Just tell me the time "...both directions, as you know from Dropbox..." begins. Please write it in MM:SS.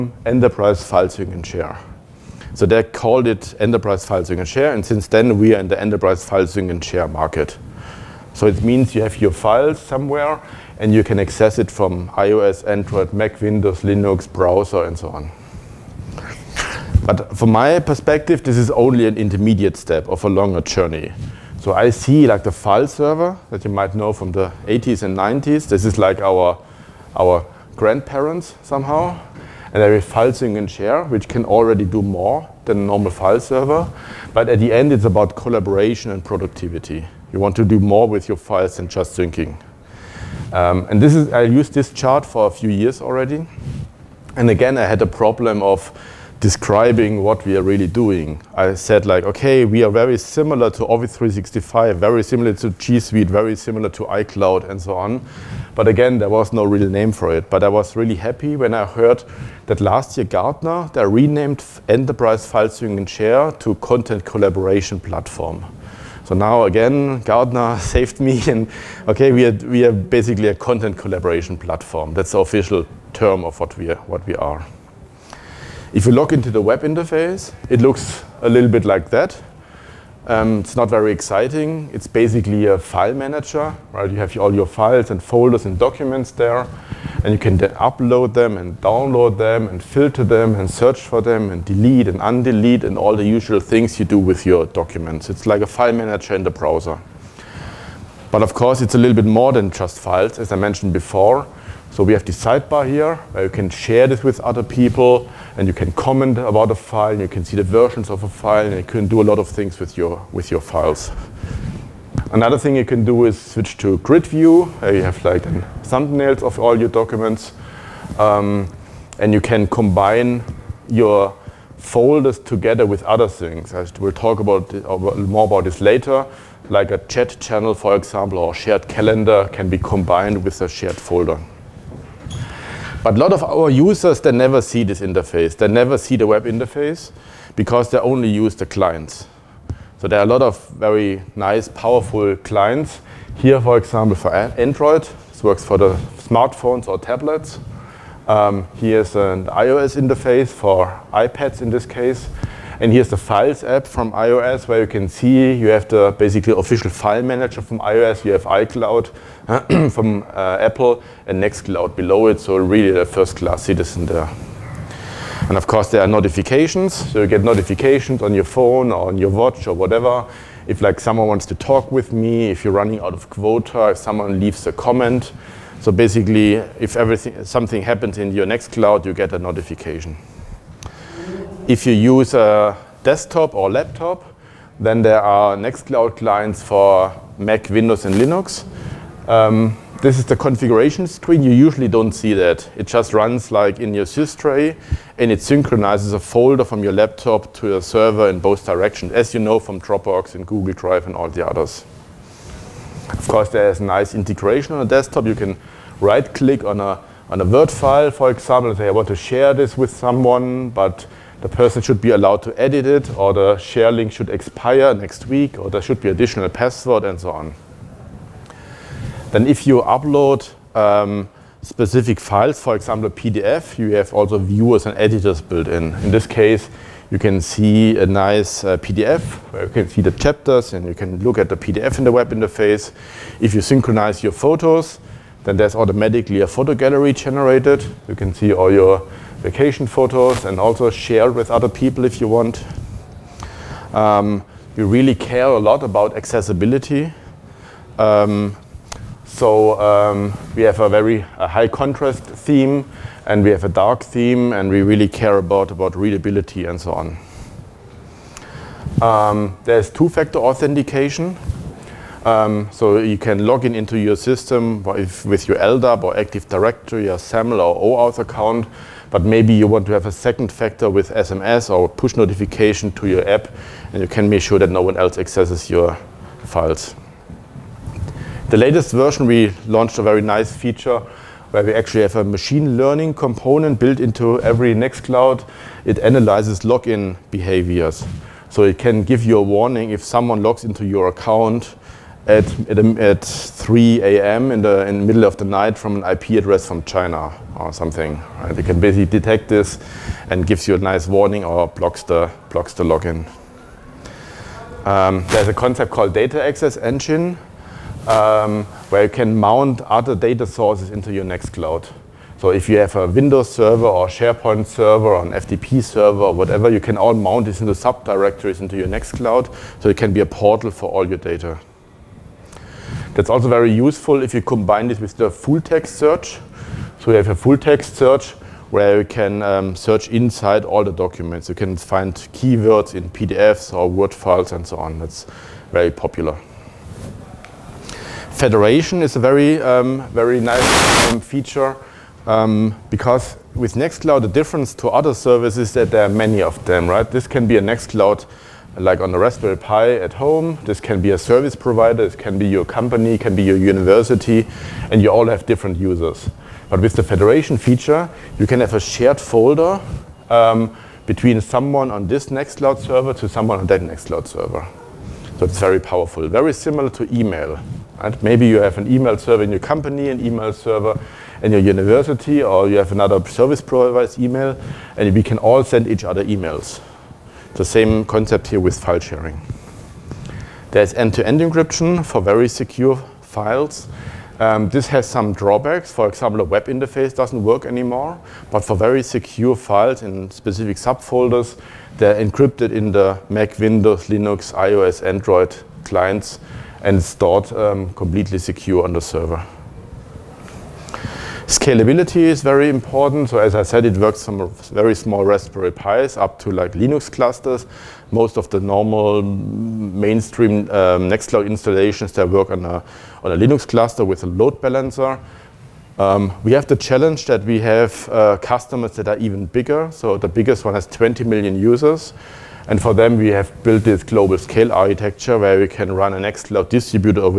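03:18.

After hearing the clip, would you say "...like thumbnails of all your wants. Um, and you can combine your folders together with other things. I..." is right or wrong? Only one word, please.
wrong.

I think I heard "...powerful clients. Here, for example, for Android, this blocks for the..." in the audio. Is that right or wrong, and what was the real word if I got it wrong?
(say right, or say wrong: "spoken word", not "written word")
wrong: "works", not "blocks".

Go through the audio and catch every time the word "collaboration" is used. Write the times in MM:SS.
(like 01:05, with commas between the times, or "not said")
00:35, 01:04, 01:10.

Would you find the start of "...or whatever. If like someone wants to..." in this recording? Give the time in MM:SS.
02:49.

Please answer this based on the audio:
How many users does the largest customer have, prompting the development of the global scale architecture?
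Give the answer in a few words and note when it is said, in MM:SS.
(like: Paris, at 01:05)
20 million, at 07:00.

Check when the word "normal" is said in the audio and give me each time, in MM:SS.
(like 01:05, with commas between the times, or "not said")
00:32, 06:48.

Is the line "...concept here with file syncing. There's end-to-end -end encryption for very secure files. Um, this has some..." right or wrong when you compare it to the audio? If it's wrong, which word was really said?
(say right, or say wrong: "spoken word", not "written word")
wrong: "sharing", not "syncing".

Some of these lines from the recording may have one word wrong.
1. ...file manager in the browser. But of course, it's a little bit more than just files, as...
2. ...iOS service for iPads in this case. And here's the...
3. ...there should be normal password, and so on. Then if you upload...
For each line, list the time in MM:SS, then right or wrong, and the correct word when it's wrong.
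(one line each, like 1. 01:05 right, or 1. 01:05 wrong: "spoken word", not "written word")
1. 01:35 right
2. 02:29 wrong: "interface", not "service"
3. 03:35 wrong: "additional", not "normal".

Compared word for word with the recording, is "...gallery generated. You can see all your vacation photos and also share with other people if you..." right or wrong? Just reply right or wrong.
right.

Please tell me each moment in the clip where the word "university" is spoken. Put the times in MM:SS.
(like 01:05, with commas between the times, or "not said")
05:53, 06:11.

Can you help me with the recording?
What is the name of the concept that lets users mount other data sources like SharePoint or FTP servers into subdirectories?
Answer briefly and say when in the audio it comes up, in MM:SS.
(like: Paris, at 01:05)
data access engine, at 05:06.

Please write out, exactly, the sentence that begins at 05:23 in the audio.
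That's also very useful if you combine this with the full text search.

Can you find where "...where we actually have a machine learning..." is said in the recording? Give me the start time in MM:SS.
04:41.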